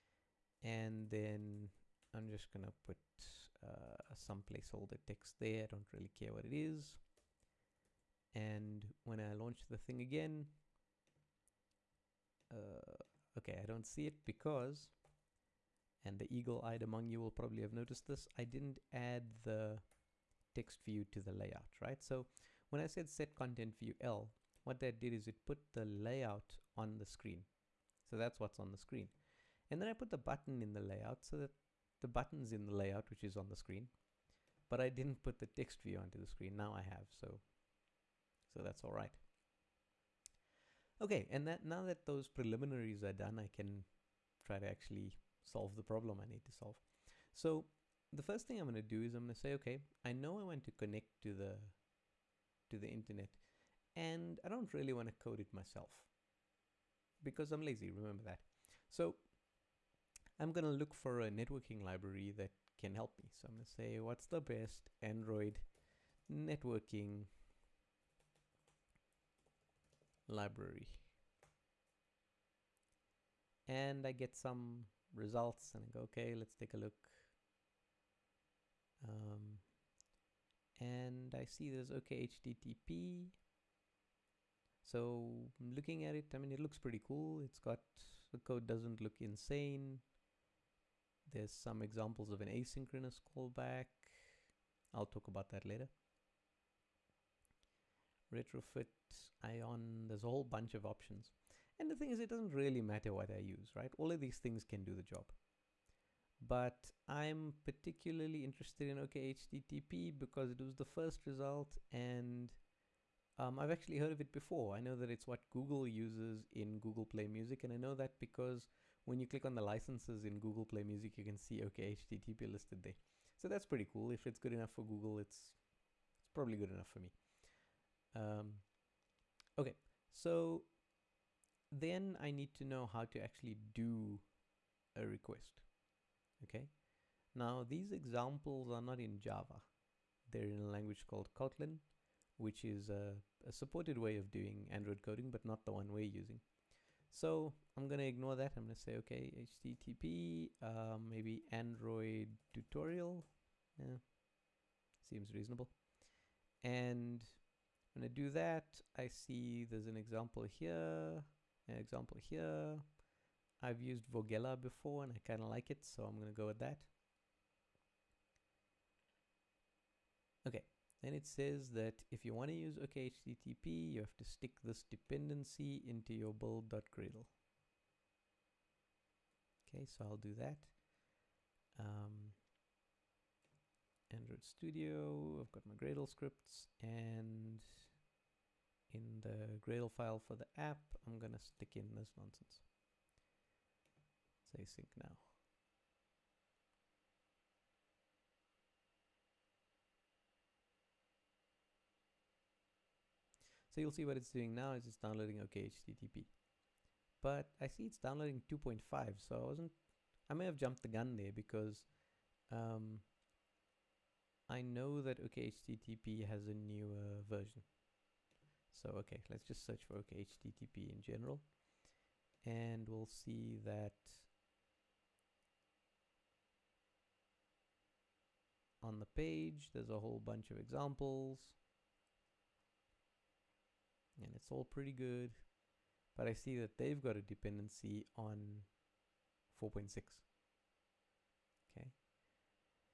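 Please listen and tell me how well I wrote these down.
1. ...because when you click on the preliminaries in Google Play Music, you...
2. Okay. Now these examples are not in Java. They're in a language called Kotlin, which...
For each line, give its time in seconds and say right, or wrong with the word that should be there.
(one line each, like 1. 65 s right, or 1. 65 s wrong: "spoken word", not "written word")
1. 118 s wrong: "licenses", not "preliminaries"
2. 136 s right.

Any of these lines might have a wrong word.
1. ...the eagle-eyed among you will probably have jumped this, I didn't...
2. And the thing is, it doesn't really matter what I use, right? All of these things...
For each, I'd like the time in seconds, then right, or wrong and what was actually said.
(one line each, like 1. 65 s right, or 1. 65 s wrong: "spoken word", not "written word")
1. 16 s wrong: "noticed", not "jumped"
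2. 101 s right.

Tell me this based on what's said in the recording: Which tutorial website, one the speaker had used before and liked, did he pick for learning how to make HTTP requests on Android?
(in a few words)
Vogella.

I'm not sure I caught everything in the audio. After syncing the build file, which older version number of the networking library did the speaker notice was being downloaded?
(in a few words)
2.5.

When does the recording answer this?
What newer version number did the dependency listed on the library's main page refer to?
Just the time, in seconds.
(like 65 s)
239 s.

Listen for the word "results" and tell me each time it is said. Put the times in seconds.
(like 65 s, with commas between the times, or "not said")
75 s, 111 s.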